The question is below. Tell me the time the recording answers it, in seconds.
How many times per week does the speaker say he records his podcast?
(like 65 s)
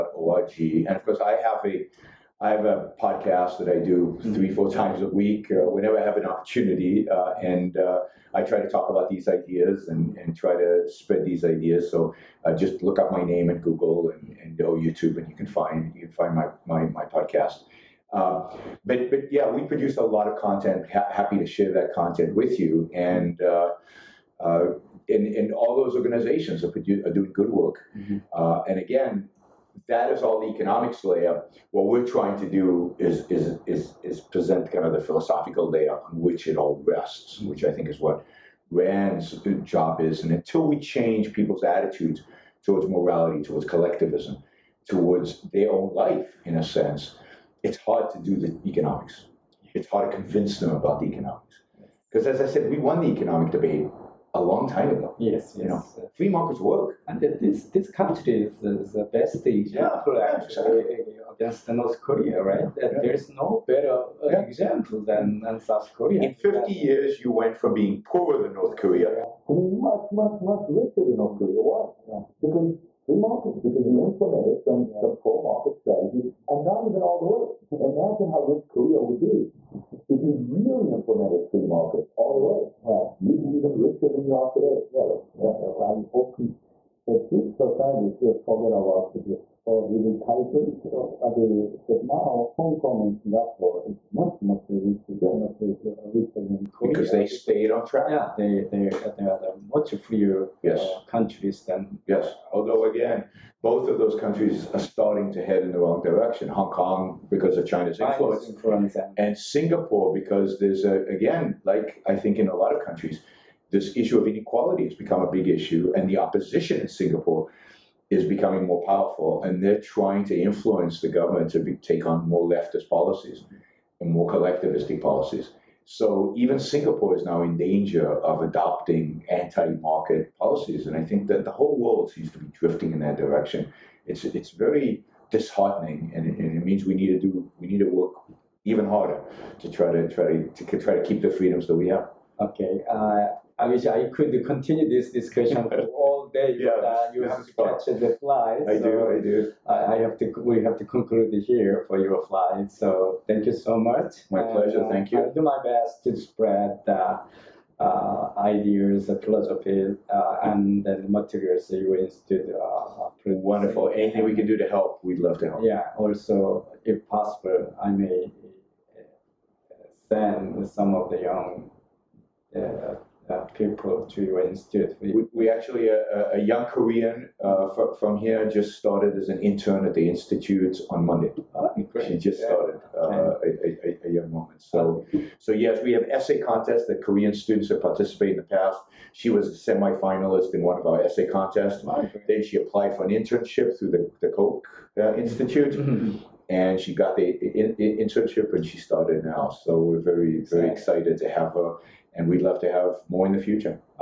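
4 s.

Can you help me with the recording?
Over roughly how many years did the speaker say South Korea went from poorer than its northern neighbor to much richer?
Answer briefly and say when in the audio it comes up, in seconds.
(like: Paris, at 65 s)
50 years, at 66 s.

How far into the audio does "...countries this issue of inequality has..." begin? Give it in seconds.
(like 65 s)
112 s.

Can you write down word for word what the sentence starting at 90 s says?
the, that now Hong Kong and Singapore is much much richer, yes.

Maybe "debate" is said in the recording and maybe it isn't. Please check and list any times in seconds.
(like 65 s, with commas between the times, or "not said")
53 s.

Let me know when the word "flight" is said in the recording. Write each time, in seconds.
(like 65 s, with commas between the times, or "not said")
148 s, 152 s.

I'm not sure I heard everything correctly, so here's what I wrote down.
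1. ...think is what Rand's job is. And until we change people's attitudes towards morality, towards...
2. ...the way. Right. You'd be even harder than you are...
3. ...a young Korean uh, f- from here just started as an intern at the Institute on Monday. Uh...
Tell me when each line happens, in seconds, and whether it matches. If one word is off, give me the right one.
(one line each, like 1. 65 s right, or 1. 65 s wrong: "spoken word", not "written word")
1. 37 s right
2. 82 s wrong: "richer", not "harder"
3. 176 s right.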